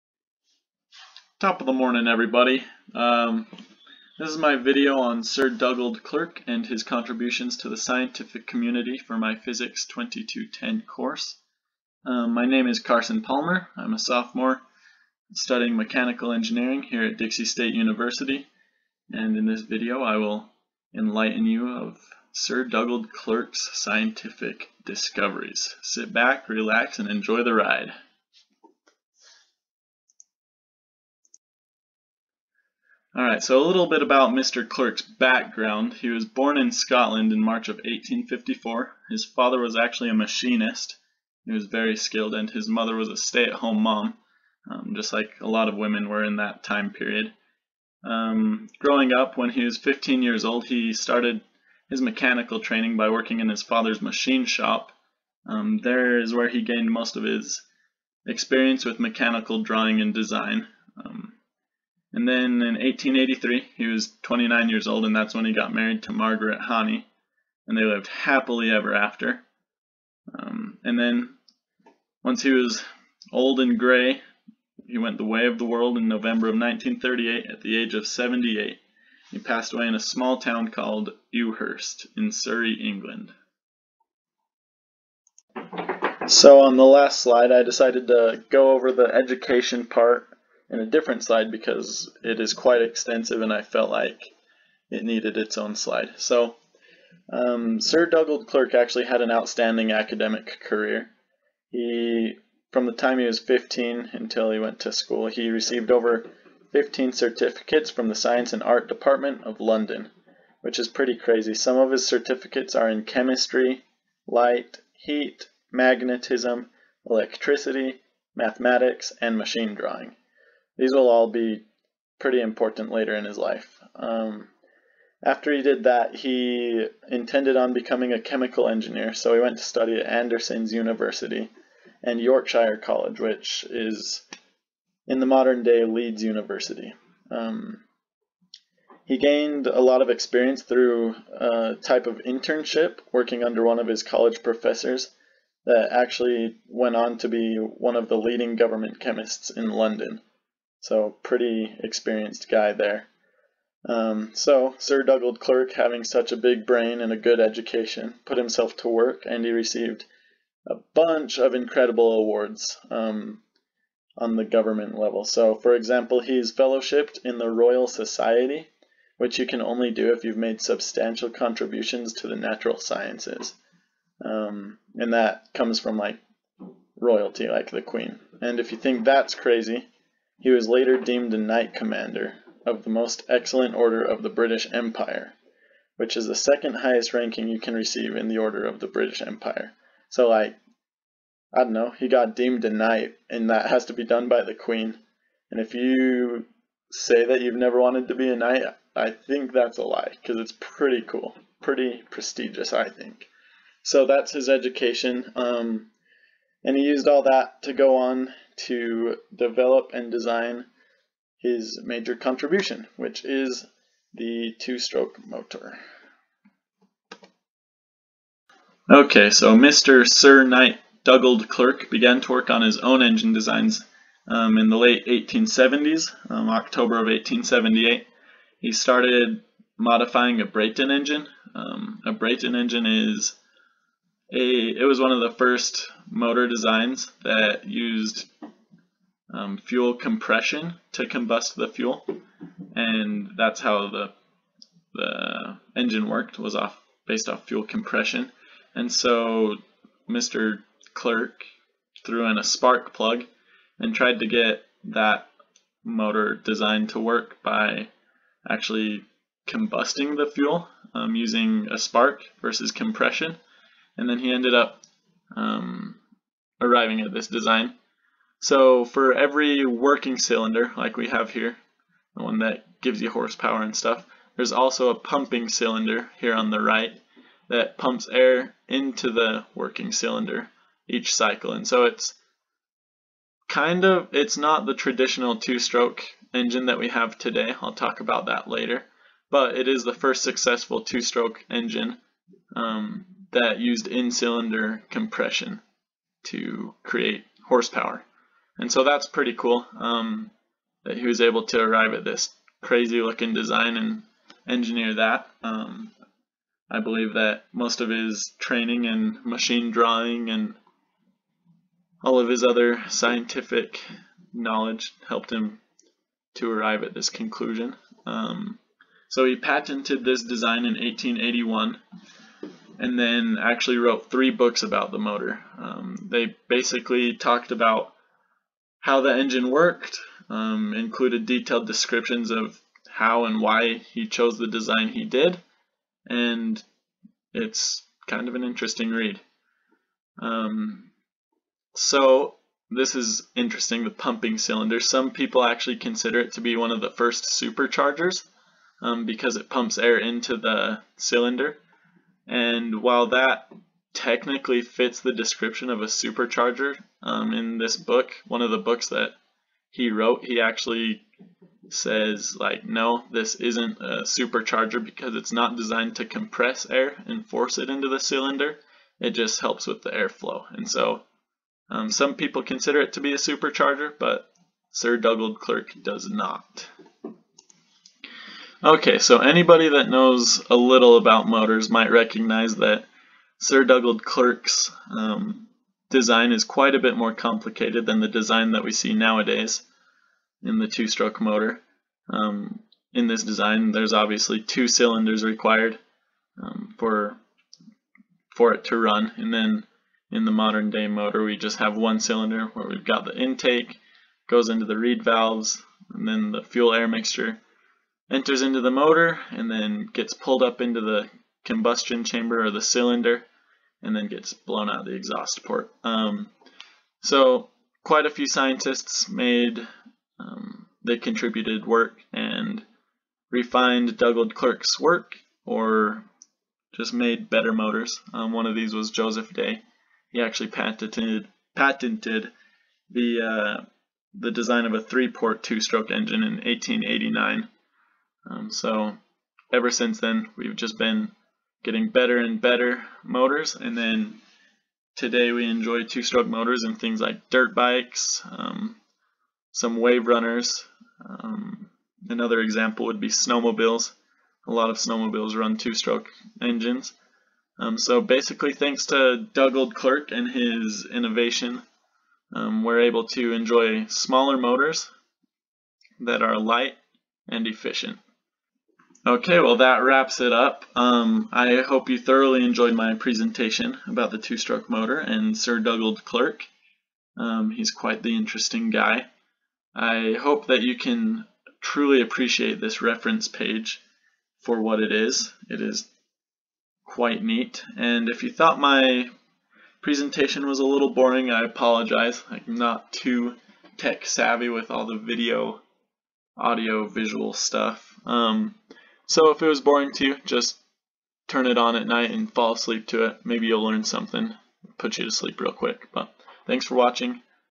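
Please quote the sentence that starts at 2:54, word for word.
Um, and that comes from like royalty, like the queen.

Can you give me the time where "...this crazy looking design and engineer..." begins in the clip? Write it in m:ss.
5:02.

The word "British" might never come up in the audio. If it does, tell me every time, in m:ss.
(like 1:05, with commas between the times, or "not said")
3:04, 3:08.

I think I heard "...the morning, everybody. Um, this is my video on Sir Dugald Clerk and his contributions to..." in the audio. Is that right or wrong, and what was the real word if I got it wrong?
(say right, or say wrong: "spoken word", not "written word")
right.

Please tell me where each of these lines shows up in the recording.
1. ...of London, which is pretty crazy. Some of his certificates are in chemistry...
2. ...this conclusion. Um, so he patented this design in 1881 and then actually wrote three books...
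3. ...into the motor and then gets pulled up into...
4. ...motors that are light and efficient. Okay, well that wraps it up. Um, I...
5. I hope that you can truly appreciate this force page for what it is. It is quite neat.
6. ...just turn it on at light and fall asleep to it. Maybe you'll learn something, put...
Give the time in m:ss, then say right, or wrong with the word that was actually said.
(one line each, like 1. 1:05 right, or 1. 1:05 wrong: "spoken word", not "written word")
1. 1:49 right
2. 5:16 right
3. 6:48 right
4. 7:44 right
5. 7:59 wrong: "reference", not "force"
6. 8:20 wrong: "night", not "light".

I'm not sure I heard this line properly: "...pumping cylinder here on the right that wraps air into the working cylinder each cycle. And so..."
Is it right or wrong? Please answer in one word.
wrong.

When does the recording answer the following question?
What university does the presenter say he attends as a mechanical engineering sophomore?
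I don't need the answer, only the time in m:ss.
0:17.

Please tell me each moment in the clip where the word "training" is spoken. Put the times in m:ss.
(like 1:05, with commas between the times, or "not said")
0:52, 5:08.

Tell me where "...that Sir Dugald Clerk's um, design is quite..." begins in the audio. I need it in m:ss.
6:22.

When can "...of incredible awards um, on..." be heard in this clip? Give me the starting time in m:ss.
2:41.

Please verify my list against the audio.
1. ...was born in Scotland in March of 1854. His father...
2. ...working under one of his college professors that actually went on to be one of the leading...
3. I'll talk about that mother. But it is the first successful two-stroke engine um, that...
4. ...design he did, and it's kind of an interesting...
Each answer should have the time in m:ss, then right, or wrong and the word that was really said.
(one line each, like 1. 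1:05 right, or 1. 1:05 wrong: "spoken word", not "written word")
1. 0:36 right
2. 2:23 right
3. 4:47 wrong: "later", not "mother"
4. 5:34 right.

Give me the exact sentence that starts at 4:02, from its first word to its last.
And that's how the, the engine worked, was off based off fuel compression.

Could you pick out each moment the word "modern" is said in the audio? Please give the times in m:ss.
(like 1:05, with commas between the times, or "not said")
2:15, 6:40.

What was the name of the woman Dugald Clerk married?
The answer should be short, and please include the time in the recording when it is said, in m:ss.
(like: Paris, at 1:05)
Margaret Haney, at 1:06.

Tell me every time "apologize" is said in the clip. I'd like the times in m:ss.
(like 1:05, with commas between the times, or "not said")
8:11.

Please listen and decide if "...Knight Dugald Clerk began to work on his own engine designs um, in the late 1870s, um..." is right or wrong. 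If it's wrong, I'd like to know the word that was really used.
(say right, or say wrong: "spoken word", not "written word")
right.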